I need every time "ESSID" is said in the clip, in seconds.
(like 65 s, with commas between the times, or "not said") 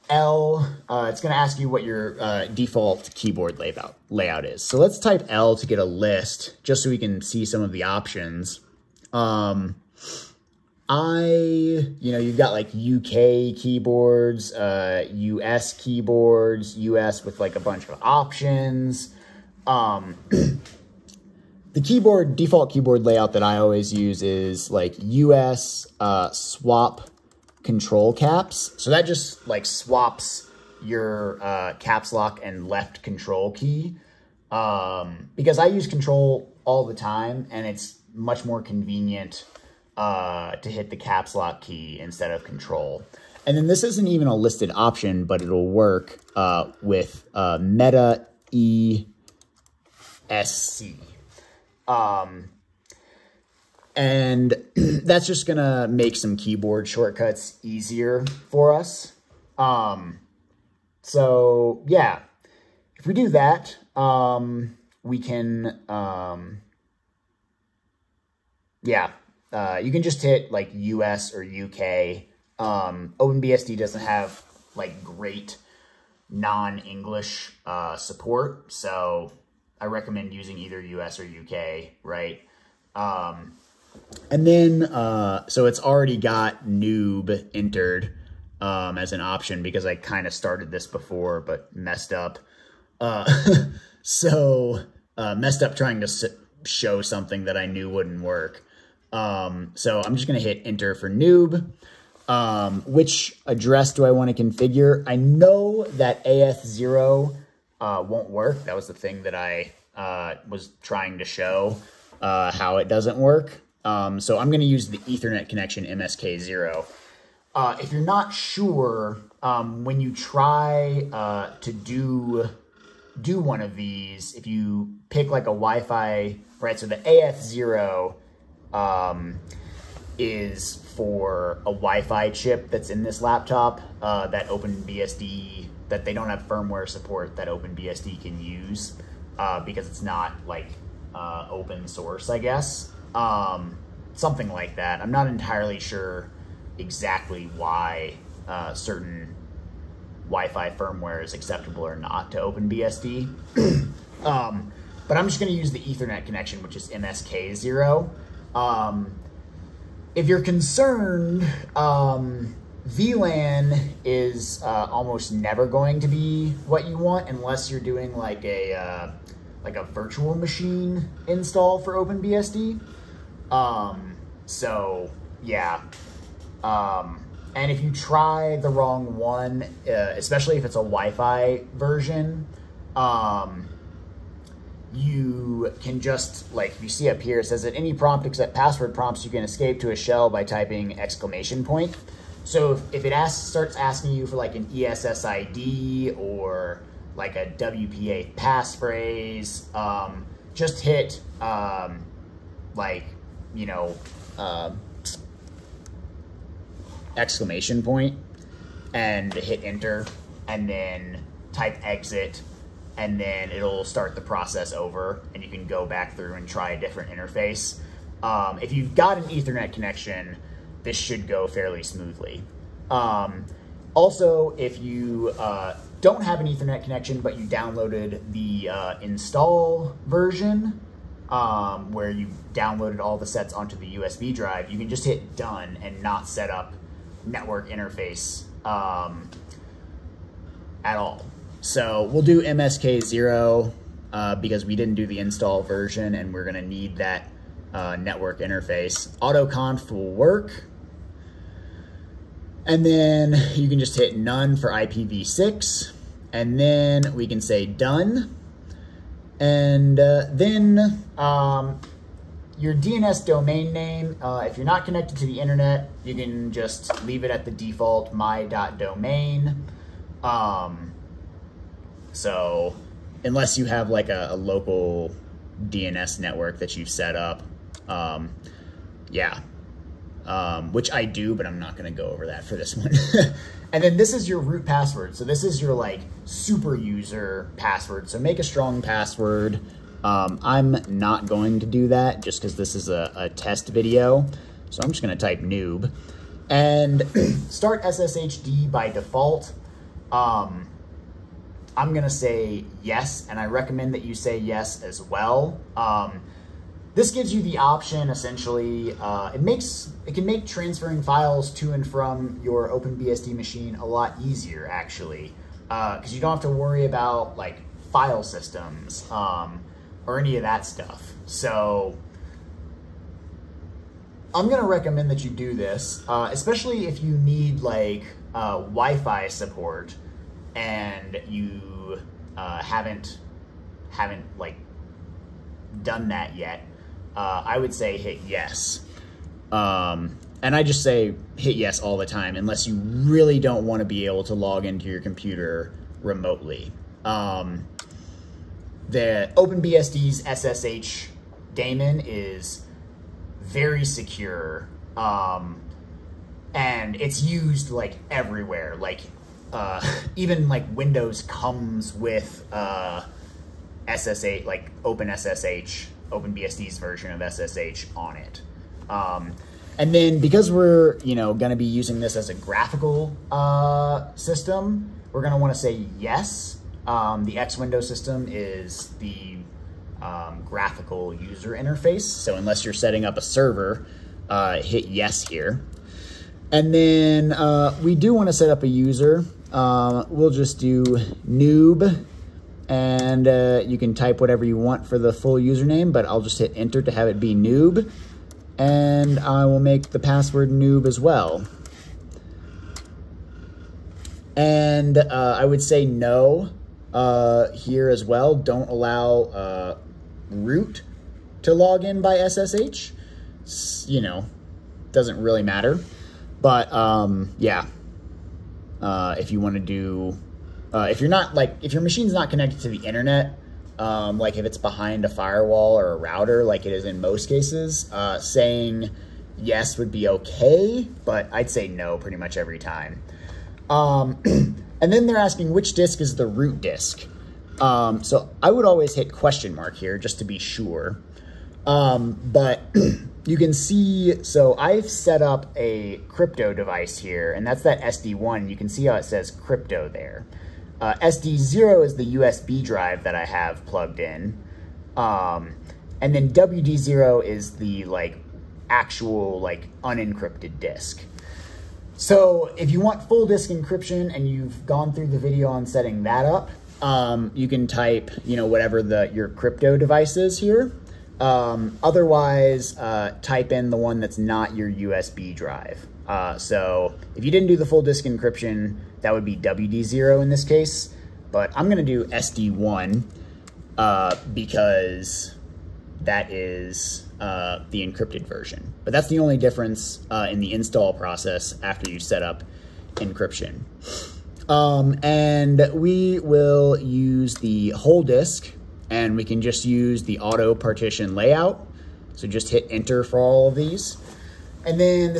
194 s.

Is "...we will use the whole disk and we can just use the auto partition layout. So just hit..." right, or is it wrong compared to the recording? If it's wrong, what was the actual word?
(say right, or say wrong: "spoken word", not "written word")
right.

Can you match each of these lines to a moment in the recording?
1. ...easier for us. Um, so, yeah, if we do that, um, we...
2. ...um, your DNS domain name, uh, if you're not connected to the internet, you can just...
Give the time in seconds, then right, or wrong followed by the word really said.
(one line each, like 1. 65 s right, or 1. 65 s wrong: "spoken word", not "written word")
1. 57 s right
2. 261 s right.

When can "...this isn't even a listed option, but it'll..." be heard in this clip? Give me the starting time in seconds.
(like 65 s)
43 s.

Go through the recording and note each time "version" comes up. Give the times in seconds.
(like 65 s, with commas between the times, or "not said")
181 s, 230 s, 245 s, 366 s, 488 s.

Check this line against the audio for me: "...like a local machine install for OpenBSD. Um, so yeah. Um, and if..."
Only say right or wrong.
wrong.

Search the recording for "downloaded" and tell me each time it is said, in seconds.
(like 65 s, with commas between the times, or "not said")
227 s, 232 s.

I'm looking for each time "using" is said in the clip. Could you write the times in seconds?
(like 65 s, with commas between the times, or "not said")
80 s, 371 s.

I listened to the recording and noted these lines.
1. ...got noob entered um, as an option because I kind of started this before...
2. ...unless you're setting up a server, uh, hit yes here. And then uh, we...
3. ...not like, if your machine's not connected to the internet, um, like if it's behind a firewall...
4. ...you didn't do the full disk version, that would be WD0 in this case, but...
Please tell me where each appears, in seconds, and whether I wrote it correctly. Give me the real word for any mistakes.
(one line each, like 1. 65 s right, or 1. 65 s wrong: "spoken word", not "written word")
1. 86 s right
2. 382 s right
3. 421 s right
4. 477 s wrong: "encryption", not "version".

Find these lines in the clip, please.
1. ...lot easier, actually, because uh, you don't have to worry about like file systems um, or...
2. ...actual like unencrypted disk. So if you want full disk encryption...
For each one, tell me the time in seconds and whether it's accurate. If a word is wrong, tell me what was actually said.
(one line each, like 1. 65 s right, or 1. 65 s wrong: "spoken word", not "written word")
1. 313 s right
2. 458 s right.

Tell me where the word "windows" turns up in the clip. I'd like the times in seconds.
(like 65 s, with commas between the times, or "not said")
360 s, 377 s.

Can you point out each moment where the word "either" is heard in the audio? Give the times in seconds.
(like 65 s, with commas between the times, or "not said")
80 s.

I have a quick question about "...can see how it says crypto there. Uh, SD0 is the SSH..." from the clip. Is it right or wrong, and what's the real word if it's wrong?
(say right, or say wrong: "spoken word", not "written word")
wrong: "USB", not "SSH".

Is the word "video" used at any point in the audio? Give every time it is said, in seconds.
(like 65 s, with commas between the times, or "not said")
293 s, 465 s.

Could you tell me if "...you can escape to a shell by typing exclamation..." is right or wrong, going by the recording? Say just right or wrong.
right.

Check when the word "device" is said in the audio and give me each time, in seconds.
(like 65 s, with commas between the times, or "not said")
446 s, 469 s.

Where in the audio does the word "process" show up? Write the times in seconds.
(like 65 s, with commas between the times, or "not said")
214 s, 490 s.